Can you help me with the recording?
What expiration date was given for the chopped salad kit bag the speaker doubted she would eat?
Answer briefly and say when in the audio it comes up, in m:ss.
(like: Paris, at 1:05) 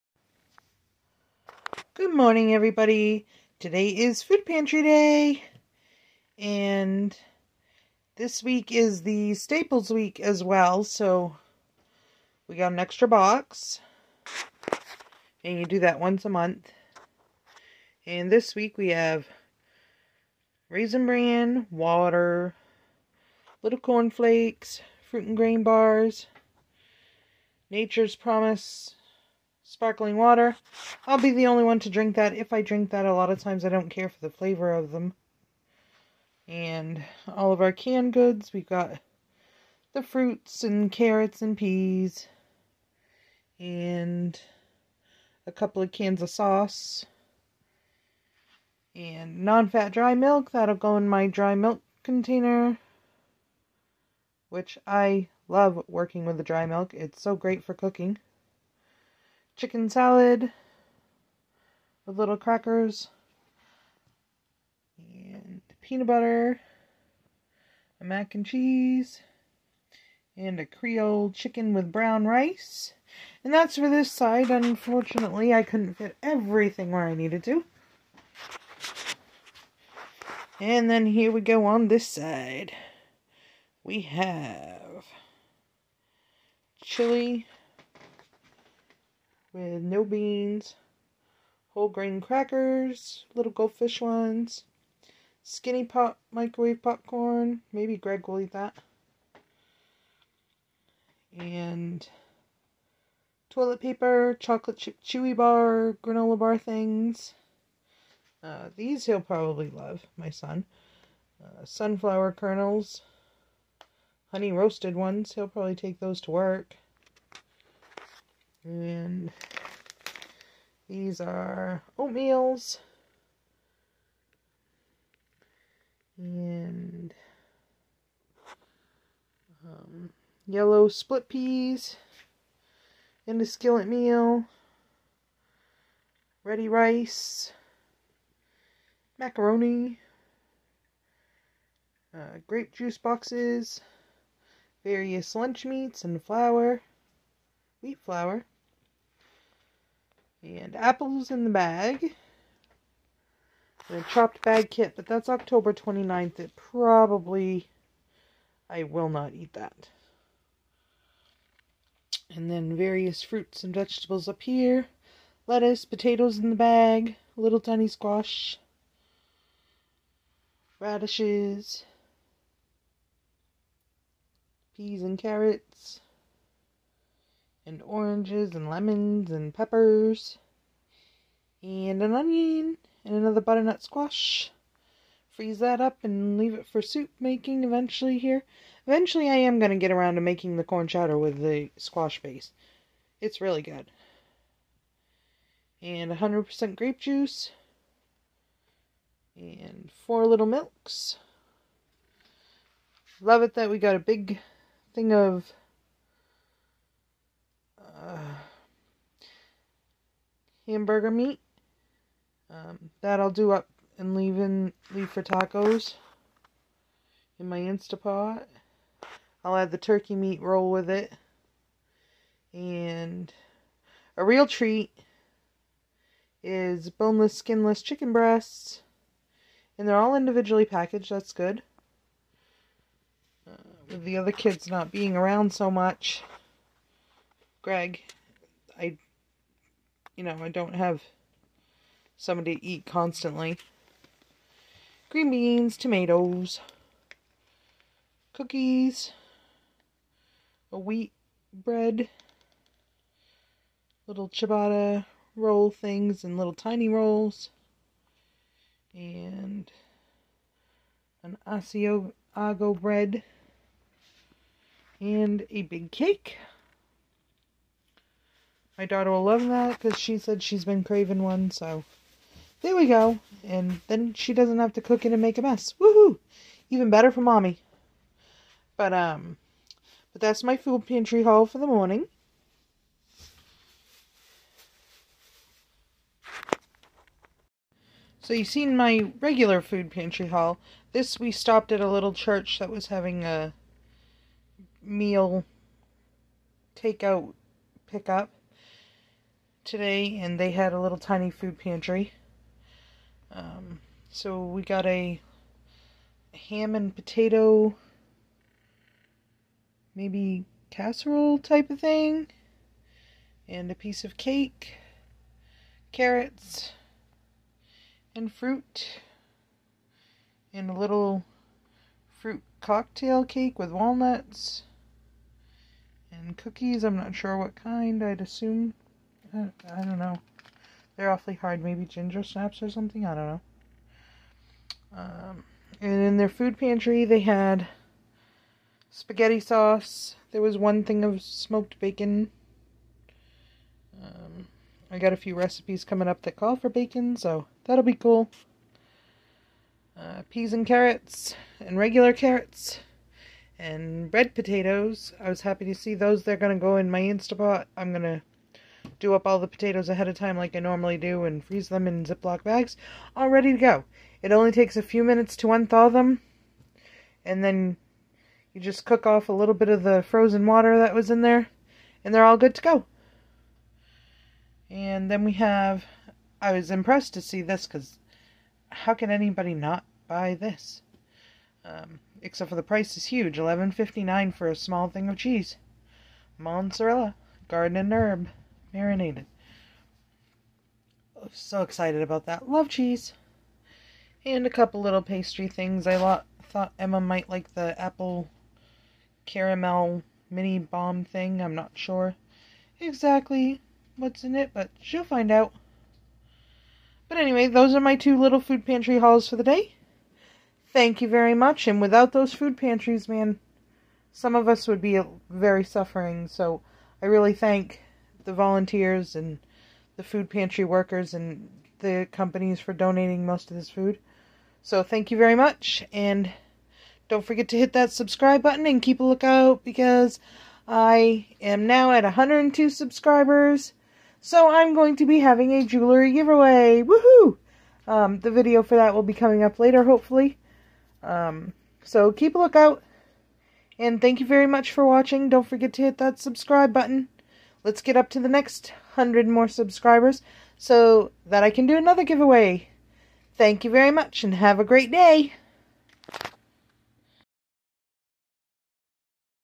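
October 29th, at 2:35.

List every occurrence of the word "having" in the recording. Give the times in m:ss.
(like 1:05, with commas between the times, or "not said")
4:52, 7:15.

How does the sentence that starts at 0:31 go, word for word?
I'll be the only one to drink that.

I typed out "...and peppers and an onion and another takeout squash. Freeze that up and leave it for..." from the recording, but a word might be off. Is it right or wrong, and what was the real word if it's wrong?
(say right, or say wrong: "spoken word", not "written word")
wrong: "butternut", not "takeout".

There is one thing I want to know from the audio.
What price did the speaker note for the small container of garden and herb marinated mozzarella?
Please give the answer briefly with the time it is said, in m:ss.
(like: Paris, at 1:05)
$11.59, at 6:23.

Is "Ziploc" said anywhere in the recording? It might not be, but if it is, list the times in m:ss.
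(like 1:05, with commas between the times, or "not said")
6:02.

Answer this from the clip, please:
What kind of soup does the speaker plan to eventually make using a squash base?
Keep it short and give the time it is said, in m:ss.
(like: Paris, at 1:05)
Corn chowder, at 3:10.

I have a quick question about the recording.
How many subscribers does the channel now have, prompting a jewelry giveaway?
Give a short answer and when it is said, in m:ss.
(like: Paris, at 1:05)
102, at 7:12.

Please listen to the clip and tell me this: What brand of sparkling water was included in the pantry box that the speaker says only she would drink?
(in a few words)
Nature's Promise.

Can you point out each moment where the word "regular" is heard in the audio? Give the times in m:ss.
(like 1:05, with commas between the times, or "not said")
4:49, 5:51.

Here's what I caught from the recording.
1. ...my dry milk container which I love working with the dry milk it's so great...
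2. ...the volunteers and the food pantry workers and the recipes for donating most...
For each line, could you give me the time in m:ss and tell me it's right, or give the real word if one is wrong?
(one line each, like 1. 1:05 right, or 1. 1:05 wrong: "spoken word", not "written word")
1. 0:51 right
2. 6:58 wrong: "companies", not "recipes".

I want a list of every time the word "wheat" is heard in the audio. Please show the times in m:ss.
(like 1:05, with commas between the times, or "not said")
2:27, 4:10.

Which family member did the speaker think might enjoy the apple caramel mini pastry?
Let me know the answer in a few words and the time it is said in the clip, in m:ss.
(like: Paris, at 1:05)
Emma, at 6:36.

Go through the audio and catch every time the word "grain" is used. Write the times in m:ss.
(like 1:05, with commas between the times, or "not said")
0:25, 1:31.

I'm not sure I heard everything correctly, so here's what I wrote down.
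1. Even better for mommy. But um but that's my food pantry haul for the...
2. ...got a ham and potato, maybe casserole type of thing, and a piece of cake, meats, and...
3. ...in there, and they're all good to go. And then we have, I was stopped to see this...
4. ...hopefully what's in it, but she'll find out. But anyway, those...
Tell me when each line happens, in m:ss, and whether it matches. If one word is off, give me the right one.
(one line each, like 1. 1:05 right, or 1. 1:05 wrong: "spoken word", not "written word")
1. 4:36 right
2. 5:04 wrong: "carrots", not "meats"
3. 6:11 wrong: "impressed", not "stopped"
4. 6:42 wrong: "exactly", not "hopefully".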